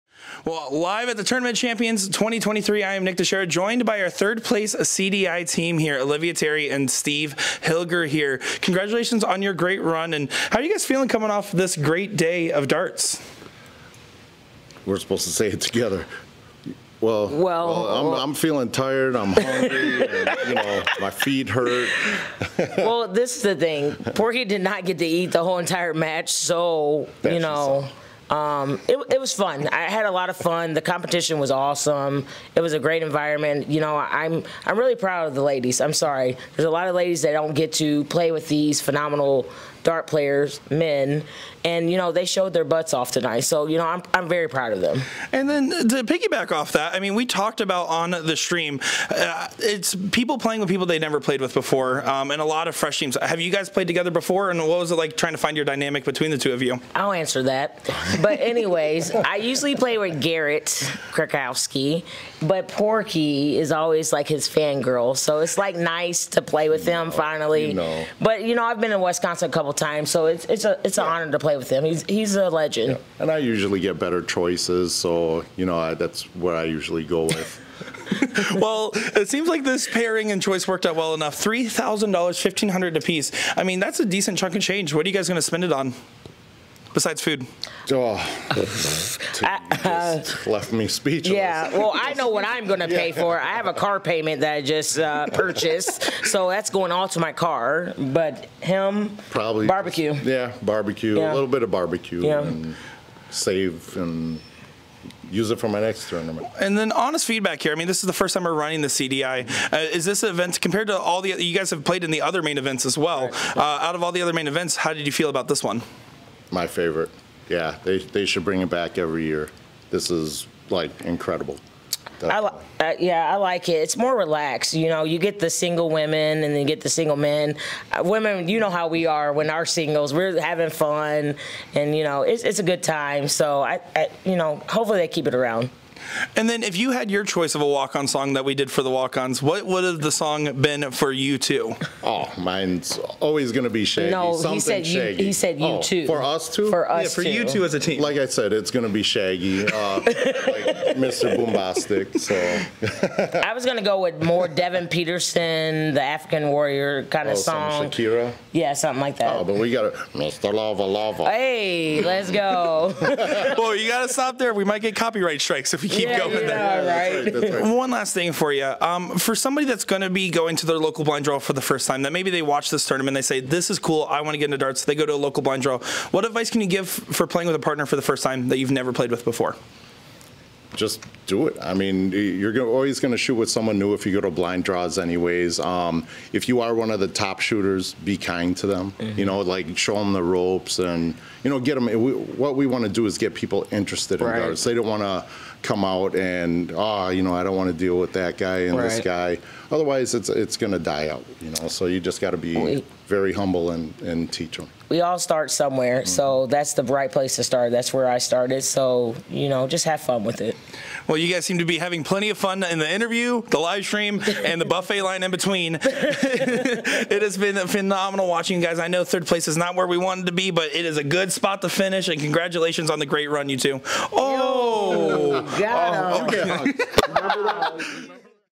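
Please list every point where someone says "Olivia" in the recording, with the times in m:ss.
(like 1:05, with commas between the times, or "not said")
0:05.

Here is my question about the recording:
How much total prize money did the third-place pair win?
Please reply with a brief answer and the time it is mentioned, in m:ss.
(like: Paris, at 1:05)
$3,000, at 1:21.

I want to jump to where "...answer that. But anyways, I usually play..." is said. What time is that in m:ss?
0:57.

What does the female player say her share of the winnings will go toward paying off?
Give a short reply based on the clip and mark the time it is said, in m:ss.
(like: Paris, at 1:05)
car payment, at 1:33.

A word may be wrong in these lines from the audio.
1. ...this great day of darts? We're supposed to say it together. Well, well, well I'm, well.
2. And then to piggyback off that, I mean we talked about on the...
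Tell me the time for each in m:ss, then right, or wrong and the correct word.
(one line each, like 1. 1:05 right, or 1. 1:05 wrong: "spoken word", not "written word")
1. 0:11 right
2. 0:45 right.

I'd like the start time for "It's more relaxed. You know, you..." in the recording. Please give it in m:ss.
2:03.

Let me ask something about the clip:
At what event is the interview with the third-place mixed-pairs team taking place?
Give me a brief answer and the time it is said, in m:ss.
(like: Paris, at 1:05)
Tournament Champions 2023, at 0:01.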